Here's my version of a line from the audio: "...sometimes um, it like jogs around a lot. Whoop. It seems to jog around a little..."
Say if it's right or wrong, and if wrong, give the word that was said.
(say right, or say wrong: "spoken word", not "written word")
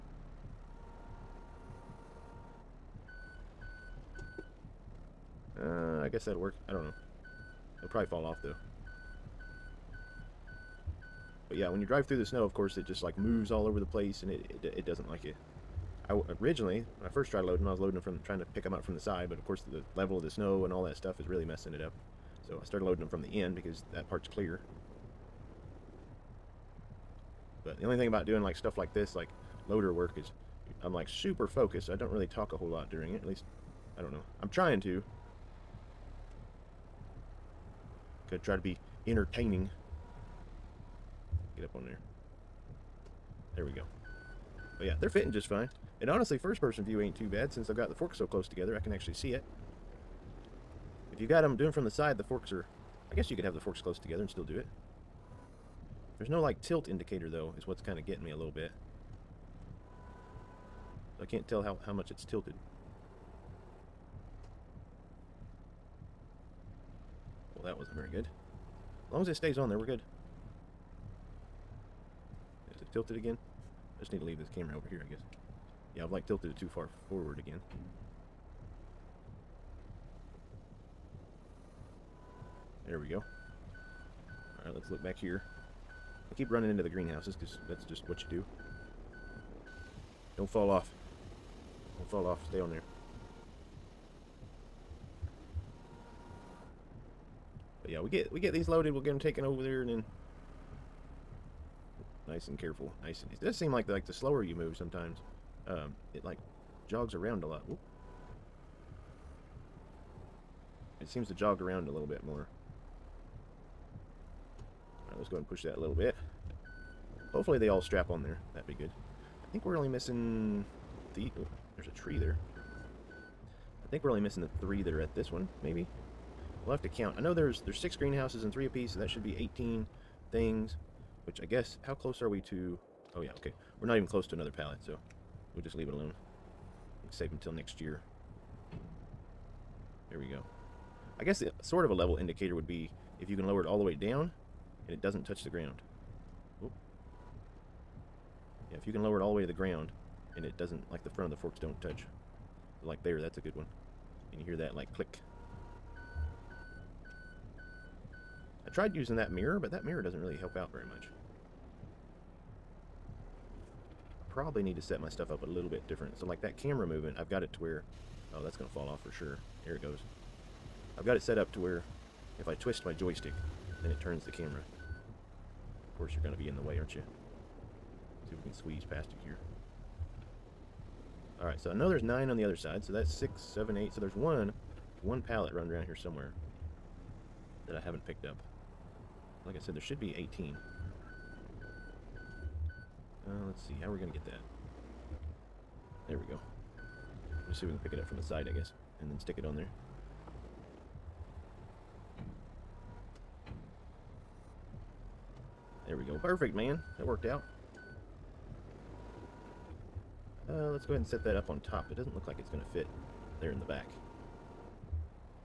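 right.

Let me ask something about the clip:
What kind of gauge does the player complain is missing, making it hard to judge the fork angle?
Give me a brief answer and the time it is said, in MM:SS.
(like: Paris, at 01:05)
Tilt indicator, at 00:56.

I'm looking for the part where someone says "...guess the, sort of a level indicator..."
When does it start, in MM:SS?
02:21.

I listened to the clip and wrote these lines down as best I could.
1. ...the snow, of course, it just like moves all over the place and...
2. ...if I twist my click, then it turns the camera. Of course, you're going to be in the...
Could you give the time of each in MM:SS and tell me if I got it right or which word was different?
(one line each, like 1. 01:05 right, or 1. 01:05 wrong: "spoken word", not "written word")
1. 00:12 right
2. 02:52 wrong: "joystick", not "click".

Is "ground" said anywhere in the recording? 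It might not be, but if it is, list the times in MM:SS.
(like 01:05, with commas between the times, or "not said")
02:25, 02:29.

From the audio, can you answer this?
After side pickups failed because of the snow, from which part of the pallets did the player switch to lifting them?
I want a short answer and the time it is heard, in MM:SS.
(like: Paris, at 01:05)
The end, at 00:23.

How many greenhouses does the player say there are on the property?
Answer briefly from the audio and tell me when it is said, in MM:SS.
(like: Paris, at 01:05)
6, at 02:07.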